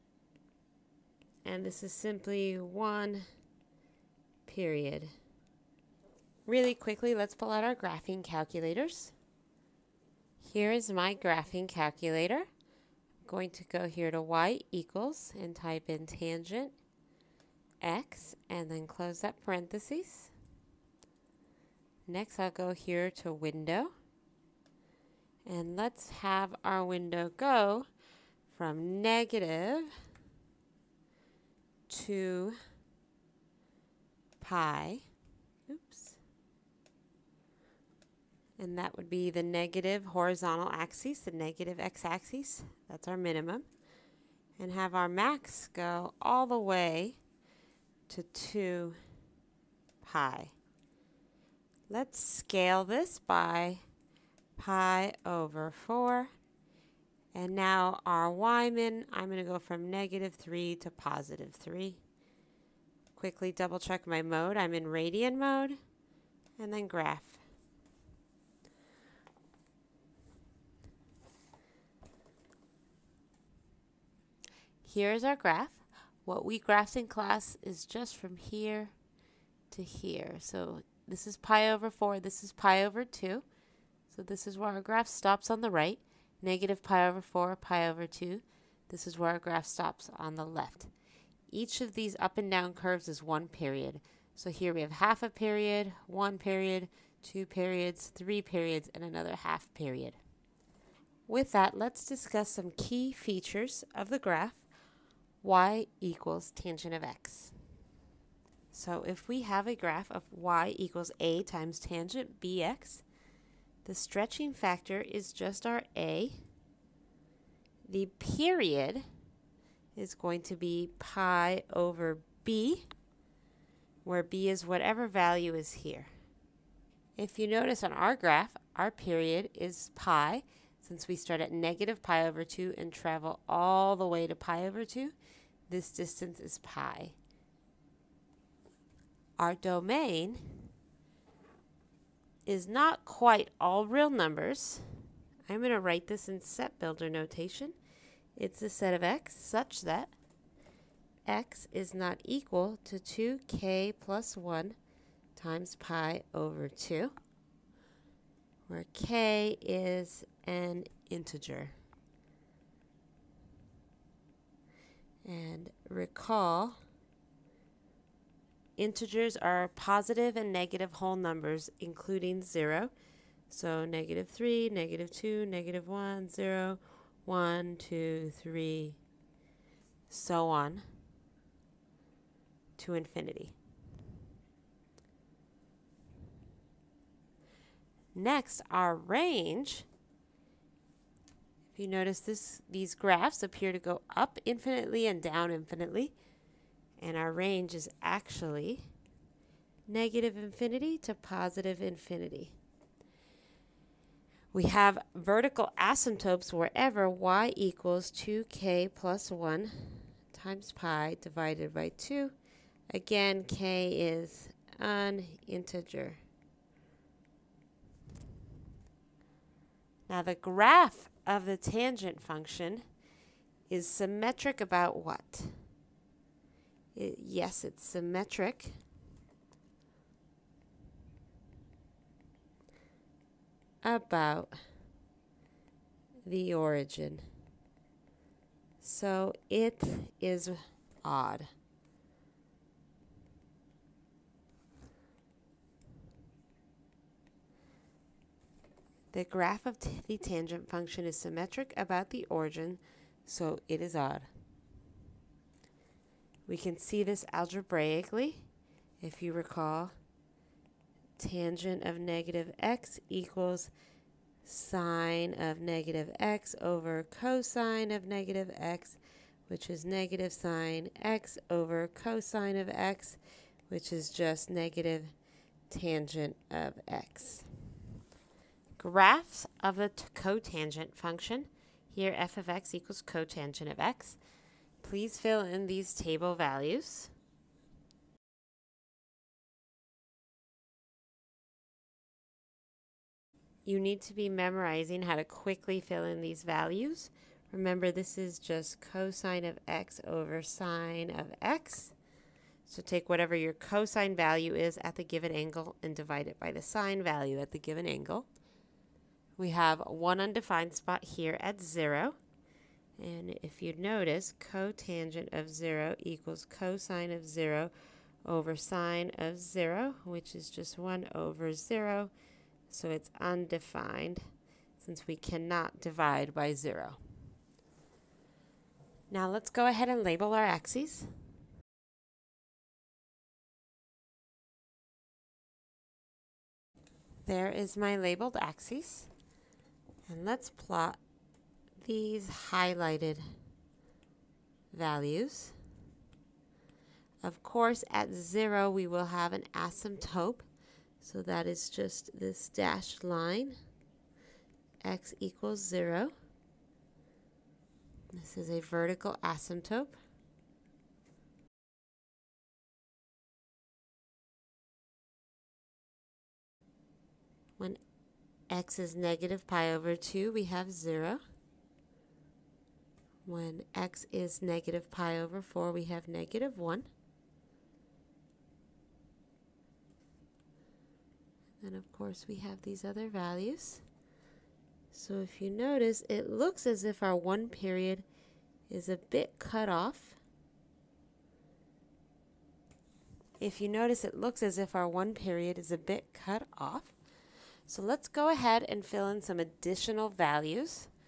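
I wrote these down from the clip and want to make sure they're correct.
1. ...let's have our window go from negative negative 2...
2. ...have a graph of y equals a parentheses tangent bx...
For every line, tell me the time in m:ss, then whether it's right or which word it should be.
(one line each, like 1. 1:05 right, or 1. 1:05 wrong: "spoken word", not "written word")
1. 0:25 right
2. 1:49 wrong: "times", not "parentheses".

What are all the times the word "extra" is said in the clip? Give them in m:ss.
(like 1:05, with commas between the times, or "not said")
not said.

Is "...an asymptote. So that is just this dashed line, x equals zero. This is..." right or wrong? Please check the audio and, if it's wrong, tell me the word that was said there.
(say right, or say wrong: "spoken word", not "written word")
right.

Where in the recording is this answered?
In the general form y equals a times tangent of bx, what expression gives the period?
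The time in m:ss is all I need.
2:00.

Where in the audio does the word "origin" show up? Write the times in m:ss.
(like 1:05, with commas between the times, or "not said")
3:56, 4:12.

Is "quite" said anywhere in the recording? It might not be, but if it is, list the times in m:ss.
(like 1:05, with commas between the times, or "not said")
2:23.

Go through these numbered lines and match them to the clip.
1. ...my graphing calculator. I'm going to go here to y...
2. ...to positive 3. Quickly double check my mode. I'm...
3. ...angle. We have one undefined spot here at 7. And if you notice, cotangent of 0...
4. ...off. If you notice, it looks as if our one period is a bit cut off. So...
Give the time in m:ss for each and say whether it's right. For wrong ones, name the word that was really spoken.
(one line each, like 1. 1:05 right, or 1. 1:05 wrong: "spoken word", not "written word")
1. 0:10 right
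2. 1:00 right
3. 5:07 wrong: "0", not "7"
4. 6:29 right.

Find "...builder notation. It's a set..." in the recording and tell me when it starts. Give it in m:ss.
2:26.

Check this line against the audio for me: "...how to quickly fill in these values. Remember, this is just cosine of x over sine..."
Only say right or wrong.
right.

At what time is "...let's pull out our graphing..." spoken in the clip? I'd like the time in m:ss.
0:07.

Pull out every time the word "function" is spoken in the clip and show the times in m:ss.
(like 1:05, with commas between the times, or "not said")
3:42, 4:10, 4:40.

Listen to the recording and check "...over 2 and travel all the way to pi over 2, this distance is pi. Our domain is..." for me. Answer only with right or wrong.
right.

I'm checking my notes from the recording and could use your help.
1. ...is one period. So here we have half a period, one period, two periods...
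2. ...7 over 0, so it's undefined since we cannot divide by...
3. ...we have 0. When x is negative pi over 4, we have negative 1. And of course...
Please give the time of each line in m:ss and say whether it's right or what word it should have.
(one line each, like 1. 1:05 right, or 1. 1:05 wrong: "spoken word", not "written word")
1. 1:33 right
2. 5:20 wrong: "1", not "7"
3. 6:10 right.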